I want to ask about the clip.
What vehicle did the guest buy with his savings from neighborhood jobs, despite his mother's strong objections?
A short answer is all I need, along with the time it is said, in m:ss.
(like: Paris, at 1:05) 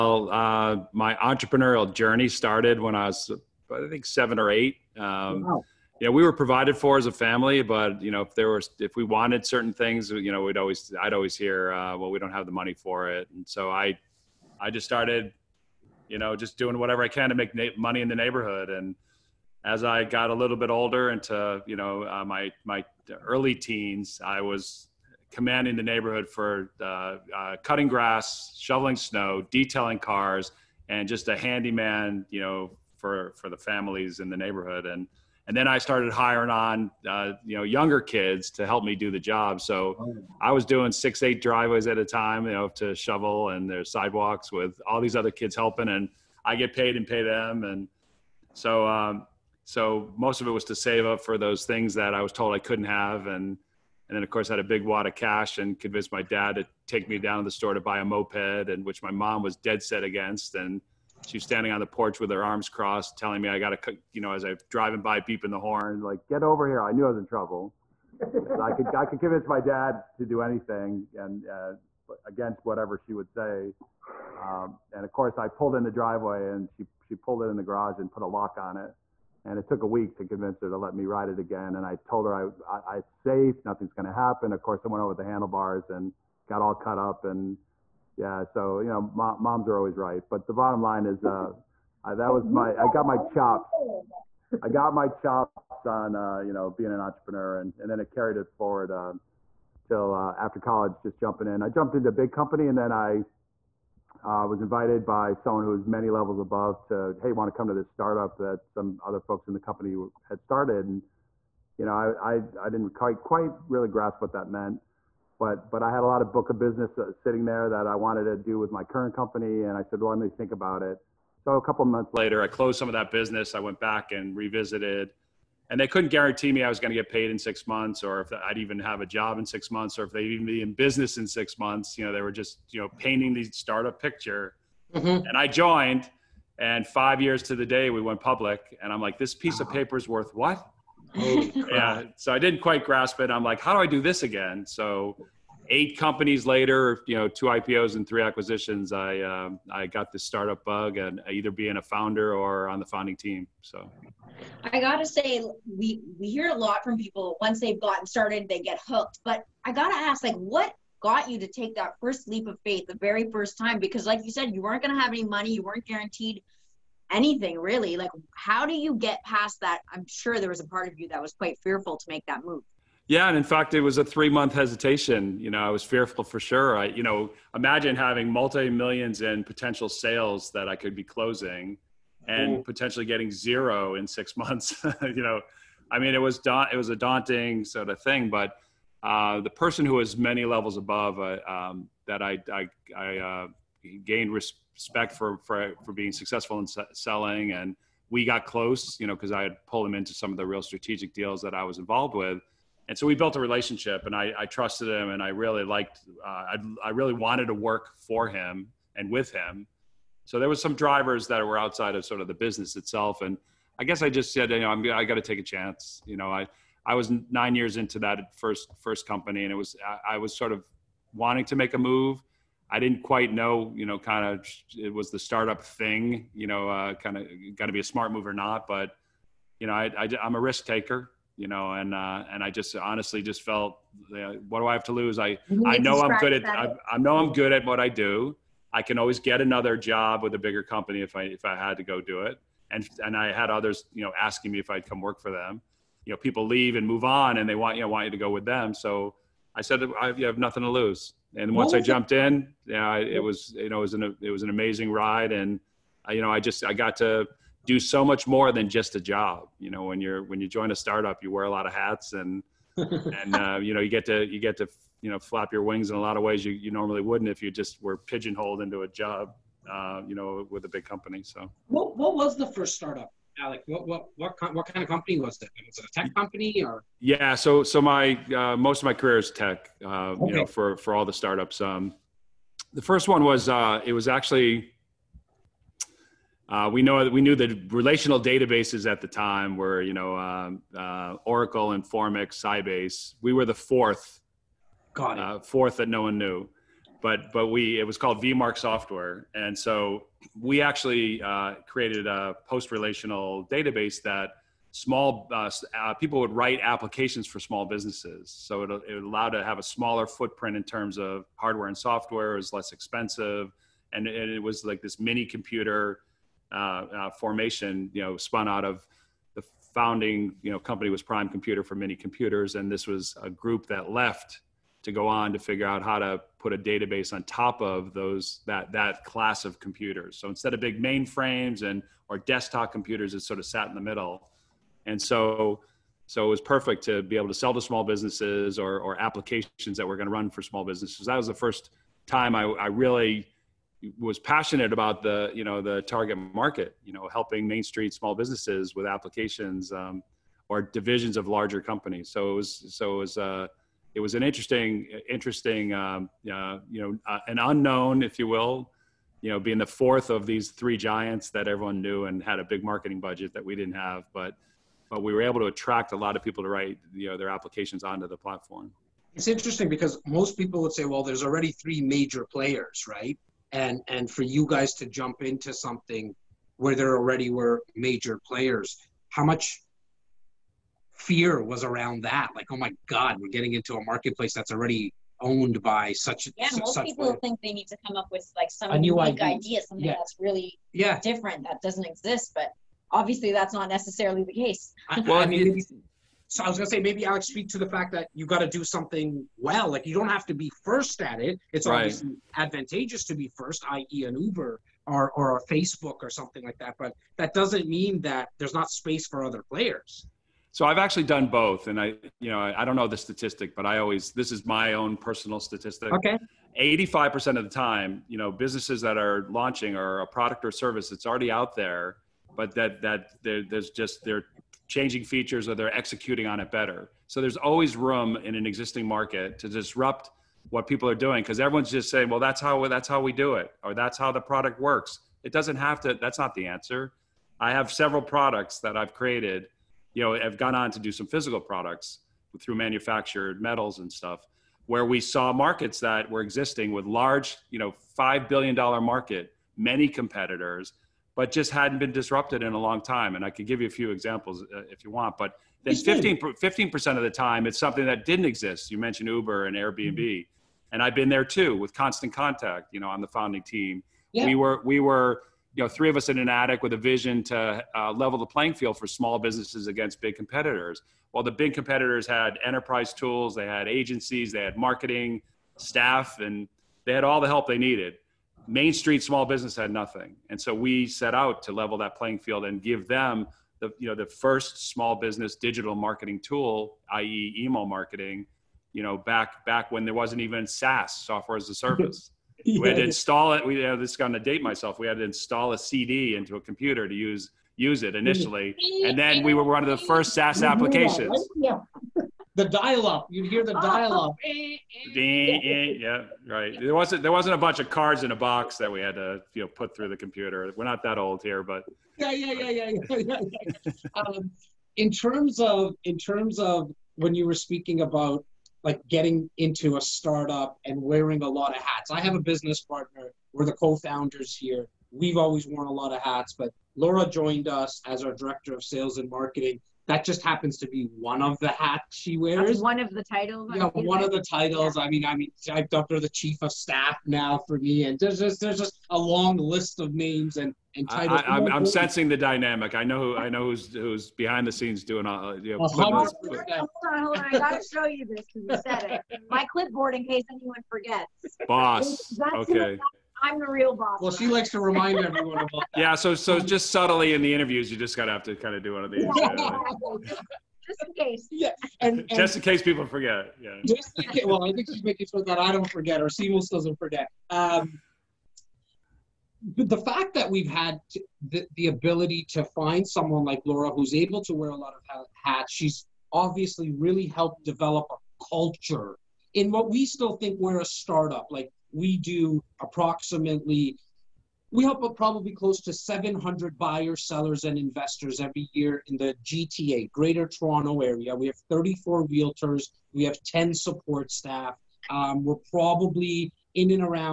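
moped, at 0:58.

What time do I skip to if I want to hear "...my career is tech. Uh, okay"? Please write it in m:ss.
4:38.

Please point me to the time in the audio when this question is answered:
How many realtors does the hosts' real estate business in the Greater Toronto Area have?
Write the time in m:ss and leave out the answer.
9:51.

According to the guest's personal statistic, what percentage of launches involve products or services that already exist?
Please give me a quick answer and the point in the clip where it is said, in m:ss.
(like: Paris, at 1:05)
85%, at 6:56.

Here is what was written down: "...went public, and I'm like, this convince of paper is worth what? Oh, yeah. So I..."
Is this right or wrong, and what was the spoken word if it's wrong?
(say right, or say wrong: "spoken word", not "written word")
wrong: "piece", not "convince".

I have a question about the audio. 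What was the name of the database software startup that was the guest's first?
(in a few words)
VMark software.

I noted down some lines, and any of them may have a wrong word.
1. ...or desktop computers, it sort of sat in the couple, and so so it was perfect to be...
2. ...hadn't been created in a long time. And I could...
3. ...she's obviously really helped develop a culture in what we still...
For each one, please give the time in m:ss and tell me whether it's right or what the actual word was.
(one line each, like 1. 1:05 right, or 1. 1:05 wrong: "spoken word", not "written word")
1. 5:32 wrong: "middle", not "couple"
2. 7:31 wrong: "disrupted", not "created"
3. 9:35 right.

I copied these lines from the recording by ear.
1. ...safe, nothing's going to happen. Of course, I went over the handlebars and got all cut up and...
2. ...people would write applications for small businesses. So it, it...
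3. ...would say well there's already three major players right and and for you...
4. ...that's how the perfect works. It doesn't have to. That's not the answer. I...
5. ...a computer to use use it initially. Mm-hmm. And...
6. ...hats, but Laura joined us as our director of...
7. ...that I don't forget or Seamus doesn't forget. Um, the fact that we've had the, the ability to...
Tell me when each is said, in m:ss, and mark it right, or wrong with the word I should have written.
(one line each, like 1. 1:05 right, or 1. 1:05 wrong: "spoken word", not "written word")
1. 1:23 right
2. 5:05 right
3. 6:10 right
4. 7:13 wrong: "product", not "perfect"
5. 8:16 right
6. 8:46 right
7. 9:25 right.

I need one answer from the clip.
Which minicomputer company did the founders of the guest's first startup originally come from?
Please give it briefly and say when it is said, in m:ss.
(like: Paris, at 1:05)
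Prime Computer, at 5:21.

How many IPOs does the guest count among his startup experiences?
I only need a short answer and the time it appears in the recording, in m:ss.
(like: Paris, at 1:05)
2, at 2:27.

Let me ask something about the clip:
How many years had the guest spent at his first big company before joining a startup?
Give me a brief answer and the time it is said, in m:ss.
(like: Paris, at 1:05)
9, at 3:37.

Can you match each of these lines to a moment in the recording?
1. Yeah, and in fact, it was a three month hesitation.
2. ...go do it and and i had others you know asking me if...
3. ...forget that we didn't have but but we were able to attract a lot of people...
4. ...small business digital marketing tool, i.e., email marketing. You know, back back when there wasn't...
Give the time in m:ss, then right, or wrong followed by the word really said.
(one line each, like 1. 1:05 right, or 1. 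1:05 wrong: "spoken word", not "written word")
1. 2:53 right
2. 4:01 right
3. 6:02 wrong: "budget", not "forget"
4. 8:04 right.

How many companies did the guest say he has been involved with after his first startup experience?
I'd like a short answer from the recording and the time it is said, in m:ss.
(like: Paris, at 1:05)
8, at 2:25.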